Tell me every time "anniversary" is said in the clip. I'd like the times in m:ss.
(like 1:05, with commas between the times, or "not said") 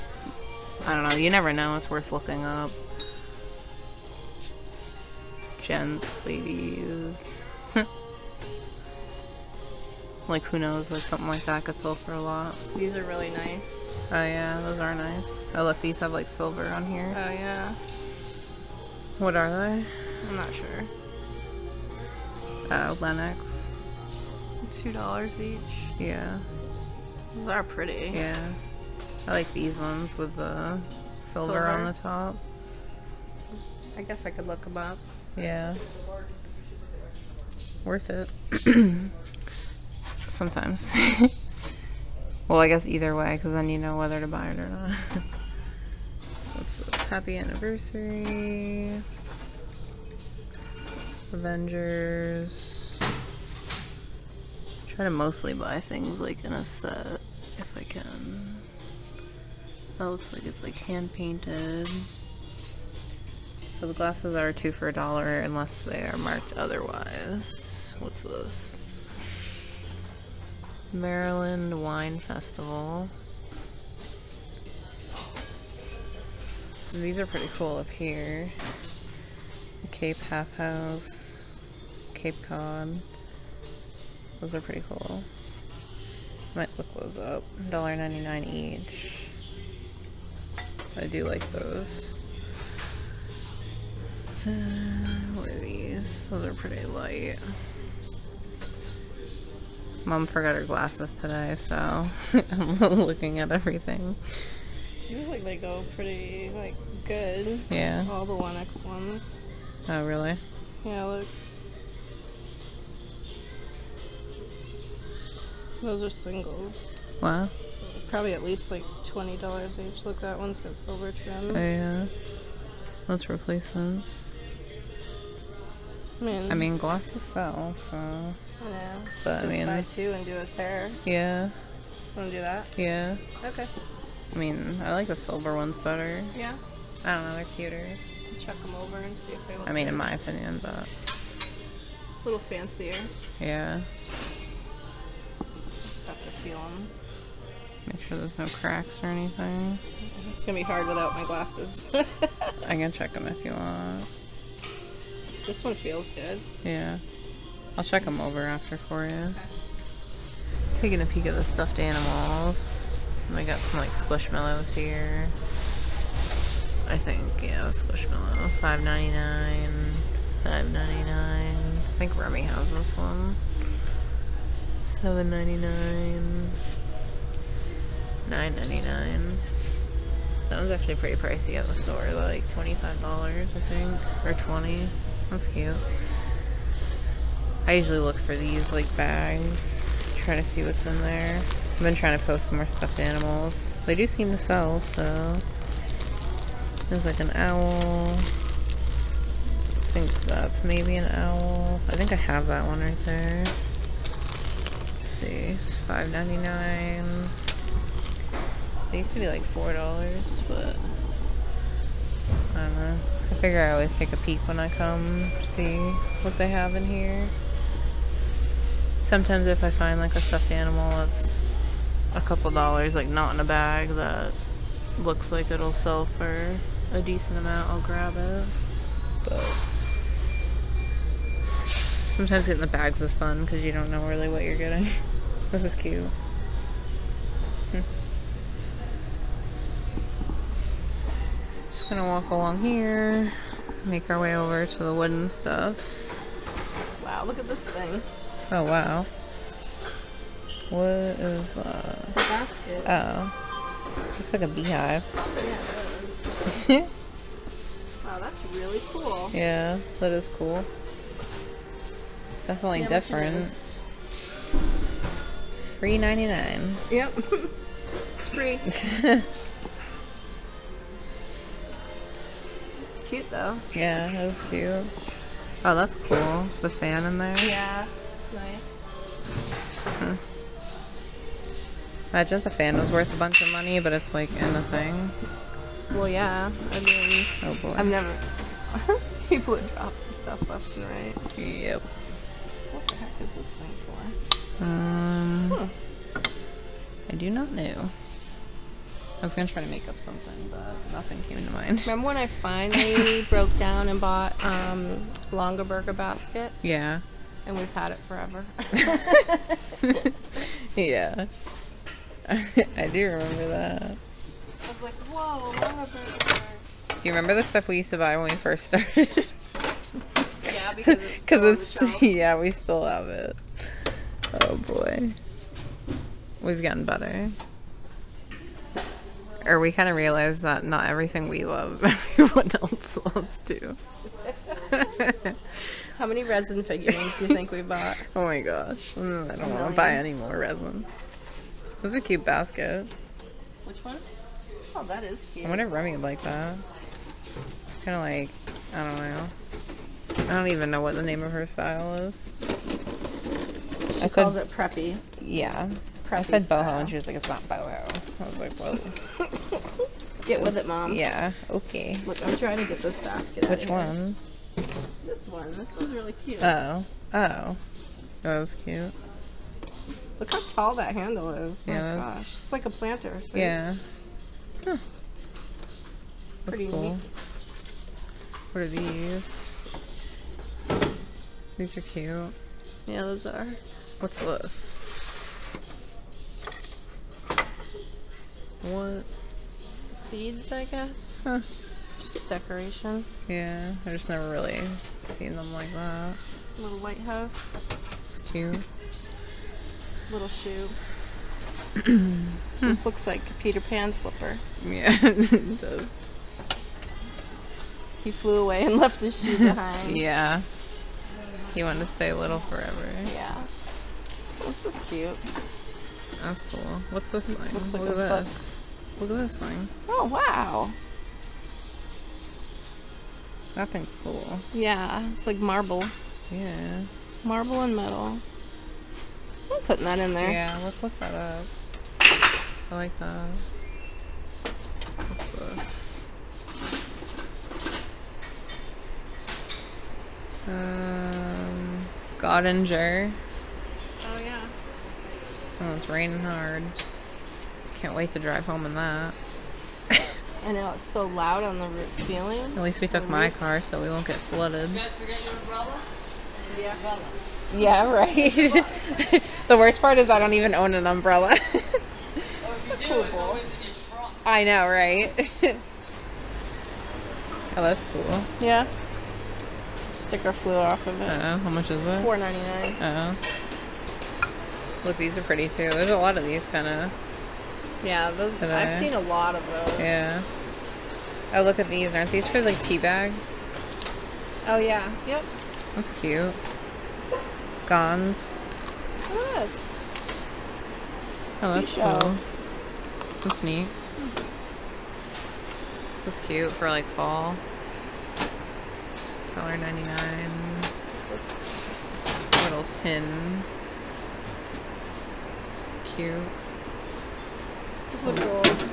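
0:47.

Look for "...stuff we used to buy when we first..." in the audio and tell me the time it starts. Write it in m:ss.
5:17.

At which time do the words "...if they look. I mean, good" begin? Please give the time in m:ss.
2:19.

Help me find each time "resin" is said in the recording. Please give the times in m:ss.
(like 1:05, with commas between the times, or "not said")
5:36, 5:40.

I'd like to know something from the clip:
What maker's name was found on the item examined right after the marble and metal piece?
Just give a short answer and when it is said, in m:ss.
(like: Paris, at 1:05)
Godinger, at 7:22.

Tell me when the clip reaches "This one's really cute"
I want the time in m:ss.
6:05.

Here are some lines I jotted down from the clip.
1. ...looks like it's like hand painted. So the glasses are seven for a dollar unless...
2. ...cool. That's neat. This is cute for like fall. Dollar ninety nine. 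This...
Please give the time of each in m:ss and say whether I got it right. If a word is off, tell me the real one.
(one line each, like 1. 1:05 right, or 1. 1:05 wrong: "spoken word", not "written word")
1. 1:00 wrong: "two", not "seven"
2. 8:11 right.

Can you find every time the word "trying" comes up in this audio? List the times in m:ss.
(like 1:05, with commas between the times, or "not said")
3:11, 6:02.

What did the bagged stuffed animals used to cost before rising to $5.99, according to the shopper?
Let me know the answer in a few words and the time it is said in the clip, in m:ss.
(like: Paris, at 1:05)
$4, at 3:29.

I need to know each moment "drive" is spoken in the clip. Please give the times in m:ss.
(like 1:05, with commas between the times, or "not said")
7:28.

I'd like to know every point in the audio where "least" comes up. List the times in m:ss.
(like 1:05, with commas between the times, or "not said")
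1:58, 7:32.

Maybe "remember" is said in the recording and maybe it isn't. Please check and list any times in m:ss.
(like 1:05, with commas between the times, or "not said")
5:01, 5:13, 5:17.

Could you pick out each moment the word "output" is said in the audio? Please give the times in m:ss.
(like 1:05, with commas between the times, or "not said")
not said.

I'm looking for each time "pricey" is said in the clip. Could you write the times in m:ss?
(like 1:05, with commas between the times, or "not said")
3:01.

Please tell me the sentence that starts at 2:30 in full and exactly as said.
It's gonna be hard without my glasses.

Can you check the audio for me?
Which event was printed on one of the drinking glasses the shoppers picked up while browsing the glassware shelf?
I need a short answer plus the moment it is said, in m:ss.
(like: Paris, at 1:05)
Maryland Wine Festival, at 1:10.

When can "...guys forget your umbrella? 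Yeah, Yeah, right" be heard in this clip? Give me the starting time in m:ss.
7:34.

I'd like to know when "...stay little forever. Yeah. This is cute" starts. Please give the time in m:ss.
6:51.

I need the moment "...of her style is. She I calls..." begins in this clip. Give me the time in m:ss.
5:51.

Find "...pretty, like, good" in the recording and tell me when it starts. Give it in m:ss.
1:45.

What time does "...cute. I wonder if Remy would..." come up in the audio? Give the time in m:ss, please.
5:45.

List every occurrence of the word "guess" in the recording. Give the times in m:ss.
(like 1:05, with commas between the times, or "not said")
0:34, 0:42, 6:30.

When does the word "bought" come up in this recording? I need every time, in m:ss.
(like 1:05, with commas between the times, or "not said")
5:03, 5:37.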